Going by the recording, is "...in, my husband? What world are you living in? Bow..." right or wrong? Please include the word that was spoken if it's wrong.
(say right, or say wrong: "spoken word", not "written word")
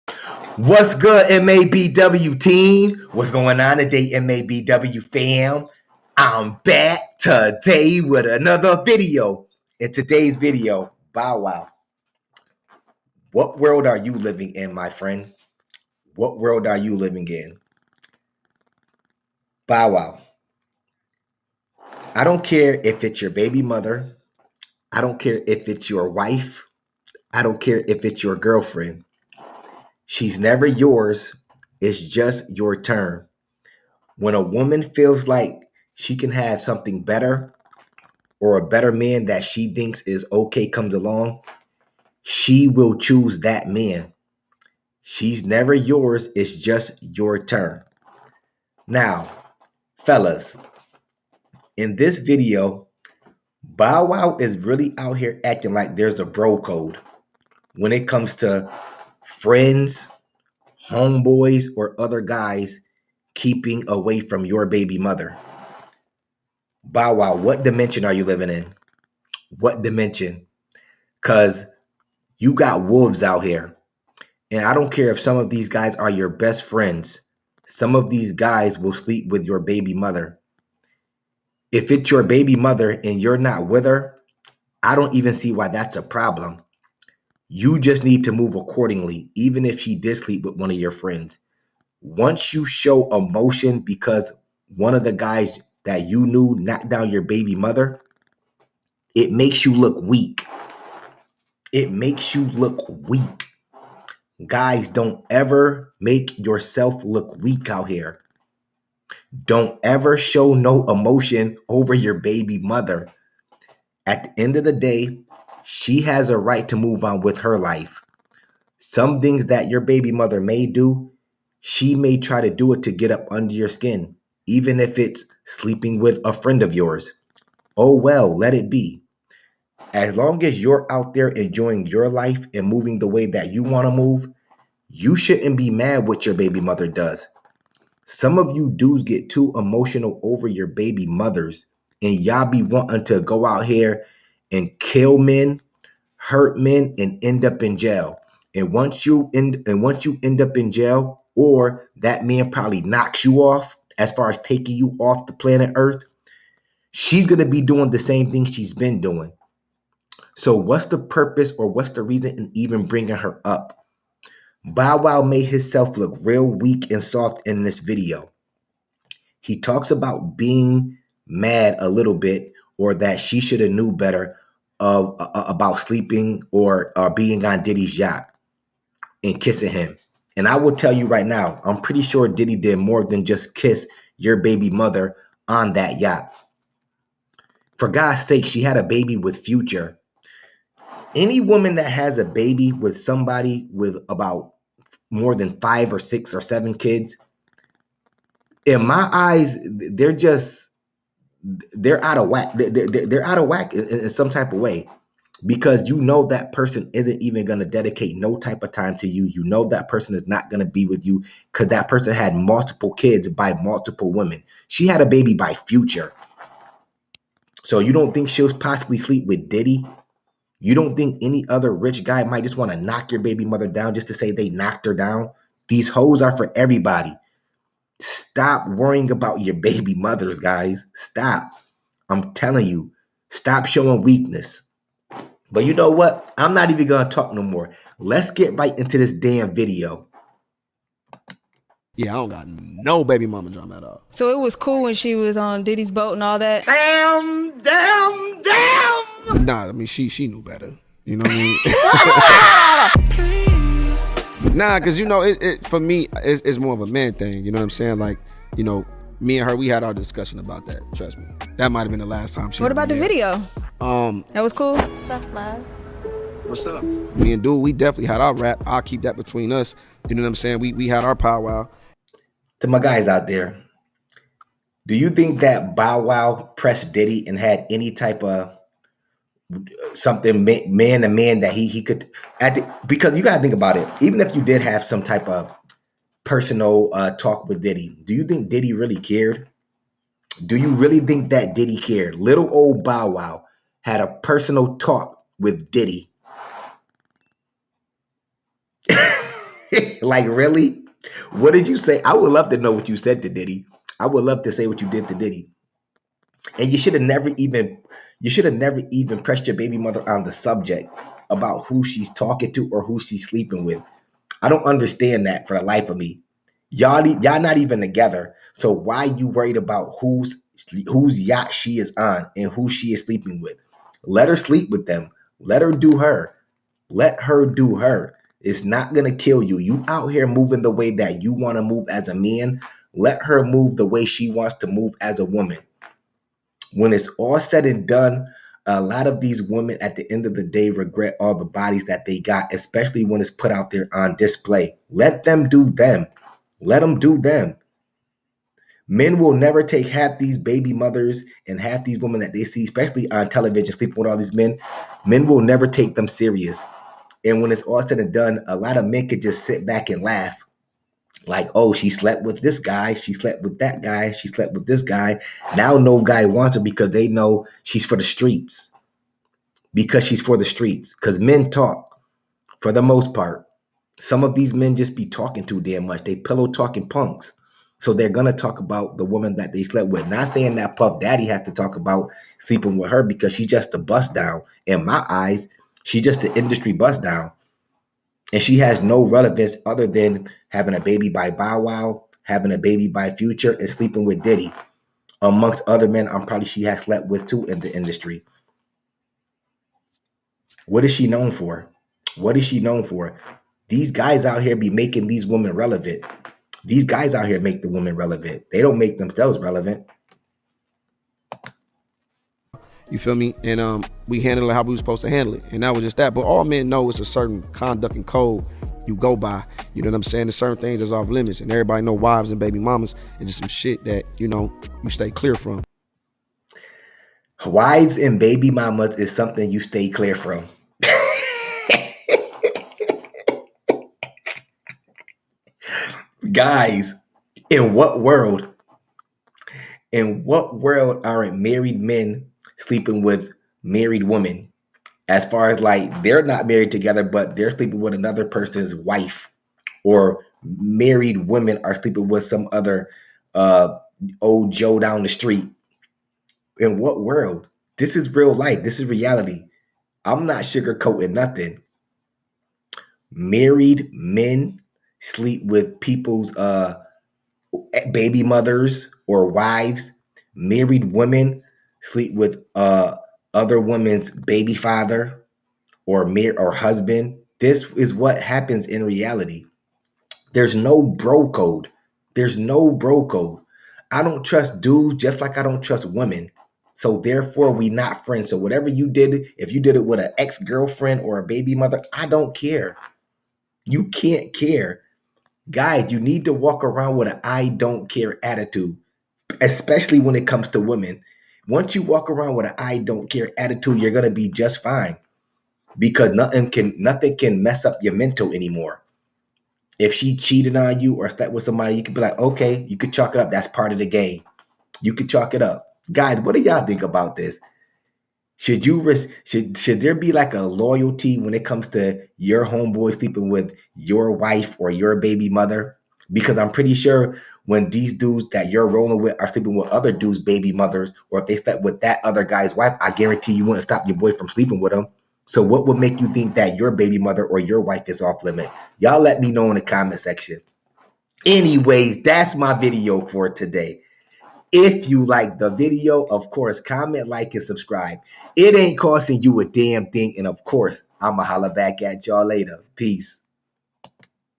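wrong: "friend", not "husband".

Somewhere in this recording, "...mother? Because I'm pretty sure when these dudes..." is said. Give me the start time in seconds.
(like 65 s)
525 s.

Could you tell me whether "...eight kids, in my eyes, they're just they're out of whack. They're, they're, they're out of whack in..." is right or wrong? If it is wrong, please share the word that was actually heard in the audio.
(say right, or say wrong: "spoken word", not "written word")
wrong: "seven", not "eight".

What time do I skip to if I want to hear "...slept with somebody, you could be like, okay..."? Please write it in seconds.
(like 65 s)
511 s.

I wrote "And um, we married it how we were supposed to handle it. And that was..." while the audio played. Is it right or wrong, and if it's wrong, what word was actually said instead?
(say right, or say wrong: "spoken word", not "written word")
wrong: "handled", not "married".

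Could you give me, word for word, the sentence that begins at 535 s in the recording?
So what would make you think that your baby mother or your wife is off limit?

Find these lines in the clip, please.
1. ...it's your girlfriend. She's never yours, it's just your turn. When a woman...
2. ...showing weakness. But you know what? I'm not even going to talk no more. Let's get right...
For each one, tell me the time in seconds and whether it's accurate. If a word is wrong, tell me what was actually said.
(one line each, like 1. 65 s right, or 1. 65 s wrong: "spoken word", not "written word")
1. 28 s right
2. 233 s right.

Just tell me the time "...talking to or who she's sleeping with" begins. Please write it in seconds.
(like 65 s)
312 s.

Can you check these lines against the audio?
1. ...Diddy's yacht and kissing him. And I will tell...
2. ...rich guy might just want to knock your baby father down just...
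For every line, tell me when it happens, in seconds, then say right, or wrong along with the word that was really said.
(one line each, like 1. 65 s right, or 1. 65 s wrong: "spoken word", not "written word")
1. 177 s right
2. 221 s wrong: "mother", not "father".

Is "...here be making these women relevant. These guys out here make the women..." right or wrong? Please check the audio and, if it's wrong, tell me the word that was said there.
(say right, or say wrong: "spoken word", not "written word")
right.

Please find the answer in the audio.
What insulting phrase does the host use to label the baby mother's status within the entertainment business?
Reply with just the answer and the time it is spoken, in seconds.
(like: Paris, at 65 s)
industry bust down, at 386 s.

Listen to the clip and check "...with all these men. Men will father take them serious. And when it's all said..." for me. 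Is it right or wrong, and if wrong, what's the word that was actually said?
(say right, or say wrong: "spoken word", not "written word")
wrong: "never", not "father".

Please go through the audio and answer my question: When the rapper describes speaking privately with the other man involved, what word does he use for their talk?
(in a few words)
powwow.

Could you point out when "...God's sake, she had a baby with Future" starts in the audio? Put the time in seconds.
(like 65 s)
187 s.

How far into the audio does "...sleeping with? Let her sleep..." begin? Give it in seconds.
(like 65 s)
323 s.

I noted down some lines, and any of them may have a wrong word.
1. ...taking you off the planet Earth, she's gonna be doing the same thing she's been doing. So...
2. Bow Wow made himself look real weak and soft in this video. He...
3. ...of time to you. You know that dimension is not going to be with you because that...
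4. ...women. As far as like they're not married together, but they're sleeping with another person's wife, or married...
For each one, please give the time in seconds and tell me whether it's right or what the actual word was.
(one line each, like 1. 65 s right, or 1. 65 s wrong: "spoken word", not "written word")
1. 154 s right
2. 164 s right
3. 208 s wrong: "person", not "dimension"
4. 444 s right.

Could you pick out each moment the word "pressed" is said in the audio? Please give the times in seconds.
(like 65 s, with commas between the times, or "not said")
276 s, 309 s.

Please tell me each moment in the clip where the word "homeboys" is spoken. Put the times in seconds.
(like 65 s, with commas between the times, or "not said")
60 s, 522 s.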